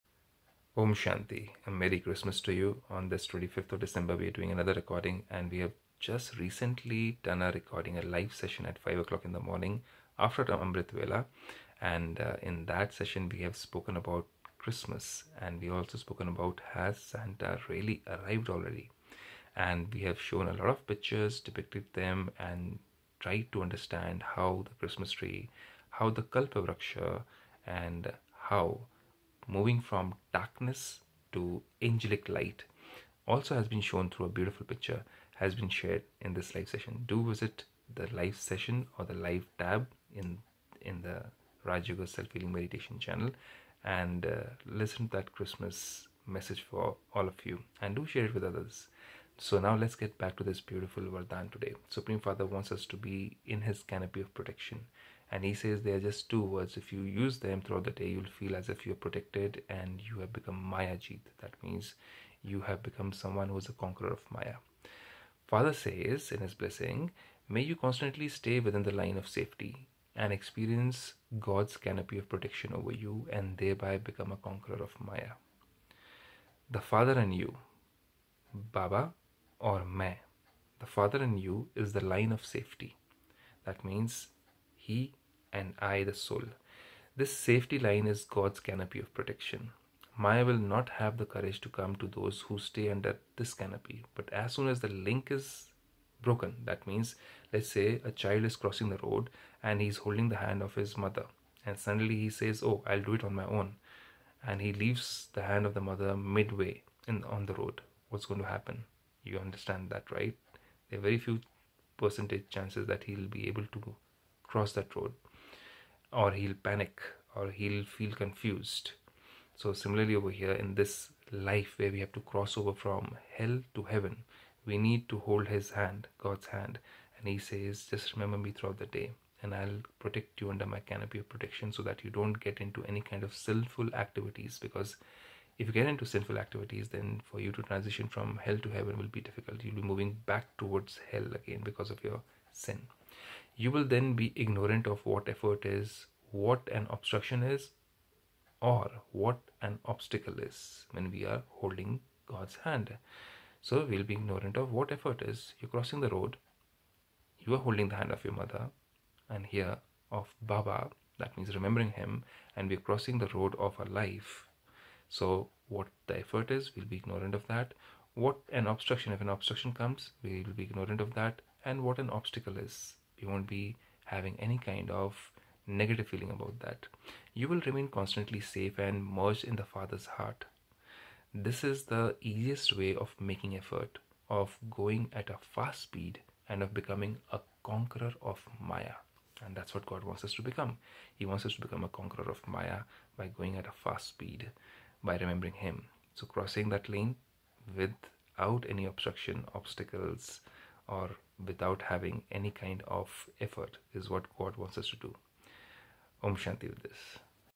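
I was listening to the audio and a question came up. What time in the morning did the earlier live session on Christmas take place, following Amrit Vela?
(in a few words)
5 o'clock.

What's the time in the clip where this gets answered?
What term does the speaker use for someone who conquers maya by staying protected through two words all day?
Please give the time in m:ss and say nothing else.
1:00.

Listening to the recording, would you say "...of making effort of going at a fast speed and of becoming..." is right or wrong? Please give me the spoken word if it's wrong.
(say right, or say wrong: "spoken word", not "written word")
right.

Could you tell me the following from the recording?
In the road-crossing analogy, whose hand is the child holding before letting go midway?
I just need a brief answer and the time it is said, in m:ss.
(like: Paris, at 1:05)
his mother, at 1:45.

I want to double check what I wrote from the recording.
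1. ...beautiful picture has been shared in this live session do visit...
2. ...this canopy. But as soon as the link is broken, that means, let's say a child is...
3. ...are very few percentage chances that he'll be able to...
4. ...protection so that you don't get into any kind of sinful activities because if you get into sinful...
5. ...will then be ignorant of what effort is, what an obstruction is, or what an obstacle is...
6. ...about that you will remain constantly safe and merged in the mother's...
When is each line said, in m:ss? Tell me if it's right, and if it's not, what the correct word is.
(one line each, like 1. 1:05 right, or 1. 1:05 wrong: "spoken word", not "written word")
1. 0:34 right
2. 1:33 right
3. 1:50 right
4. 2:11 right
5. 2:23 right
6. 2:56 wrong: "father", not "mother".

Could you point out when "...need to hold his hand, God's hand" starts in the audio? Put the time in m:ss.
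2:04.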